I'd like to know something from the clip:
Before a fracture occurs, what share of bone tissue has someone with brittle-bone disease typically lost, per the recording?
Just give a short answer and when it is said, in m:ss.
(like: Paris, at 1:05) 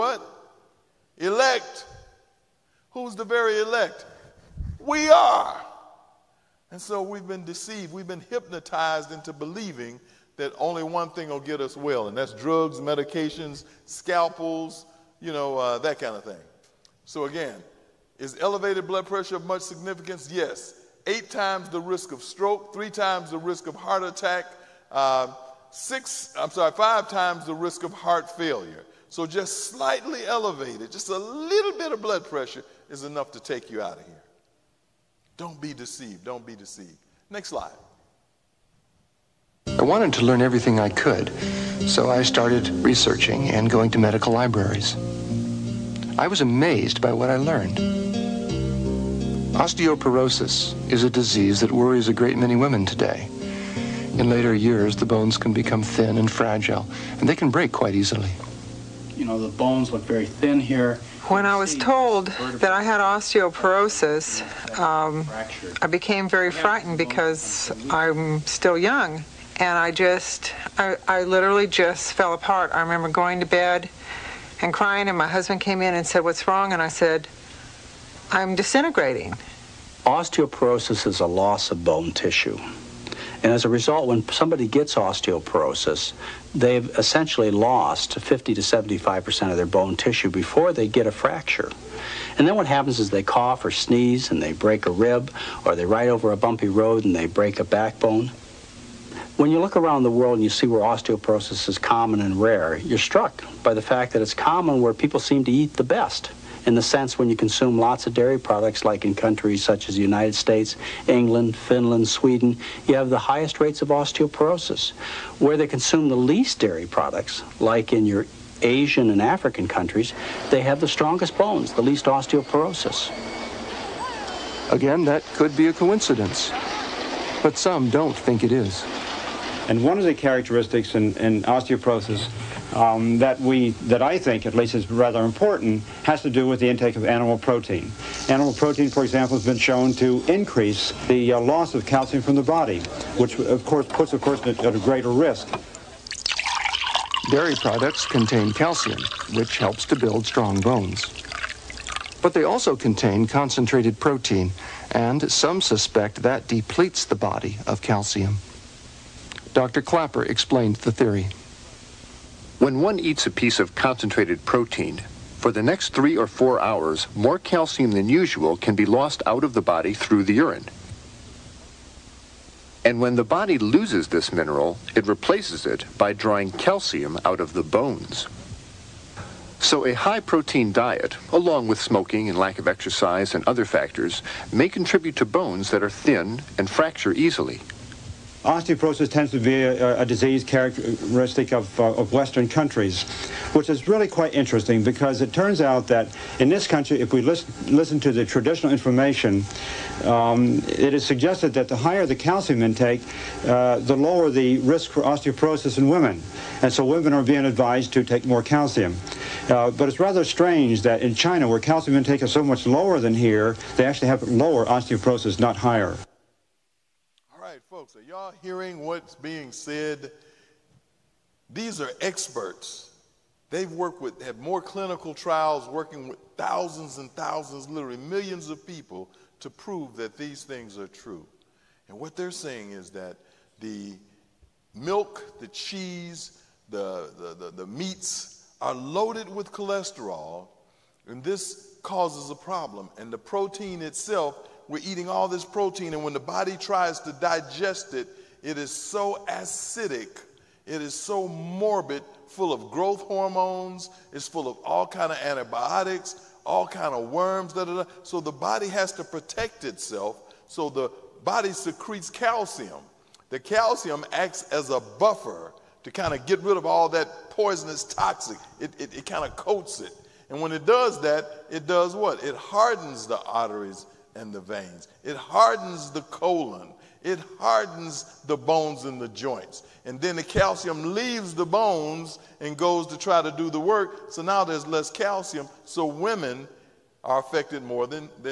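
50 to 75%, at 1:28.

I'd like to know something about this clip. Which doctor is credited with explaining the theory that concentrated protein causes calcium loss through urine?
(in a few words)
Dr. Klaper.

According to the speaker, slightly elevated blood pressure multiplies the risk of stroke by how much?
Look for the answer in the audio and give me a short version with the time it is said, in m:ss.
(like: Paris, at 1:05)
8 times, at 0:21.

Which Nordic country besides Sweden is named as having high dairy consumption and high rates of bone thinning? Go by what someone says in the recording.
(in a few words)
Finland.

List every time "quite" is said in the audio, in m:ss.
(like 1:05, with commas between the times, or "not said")
0:57, 3:14.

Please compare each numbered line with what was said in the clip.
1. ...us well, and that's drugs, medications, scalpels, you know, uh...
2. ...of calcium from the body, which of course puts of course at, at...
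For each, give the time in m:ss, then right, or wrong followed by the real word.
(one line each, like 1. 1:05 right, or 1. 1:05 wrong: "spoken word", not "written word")
1. 0:11 right
2. 2:21 right.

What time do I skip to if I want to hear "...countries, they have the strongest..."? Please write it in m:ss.
1:59.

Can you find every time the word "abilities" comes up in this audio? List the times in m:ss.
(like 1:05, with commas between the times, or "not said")
not said.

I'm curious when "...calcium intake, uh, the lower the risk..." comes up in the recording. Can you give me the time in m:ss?
3:22.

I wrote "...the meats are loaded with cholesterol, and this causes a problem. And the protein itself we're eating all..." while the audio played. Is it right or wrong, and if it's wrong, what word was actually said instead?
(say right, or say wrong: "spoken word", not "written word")
right.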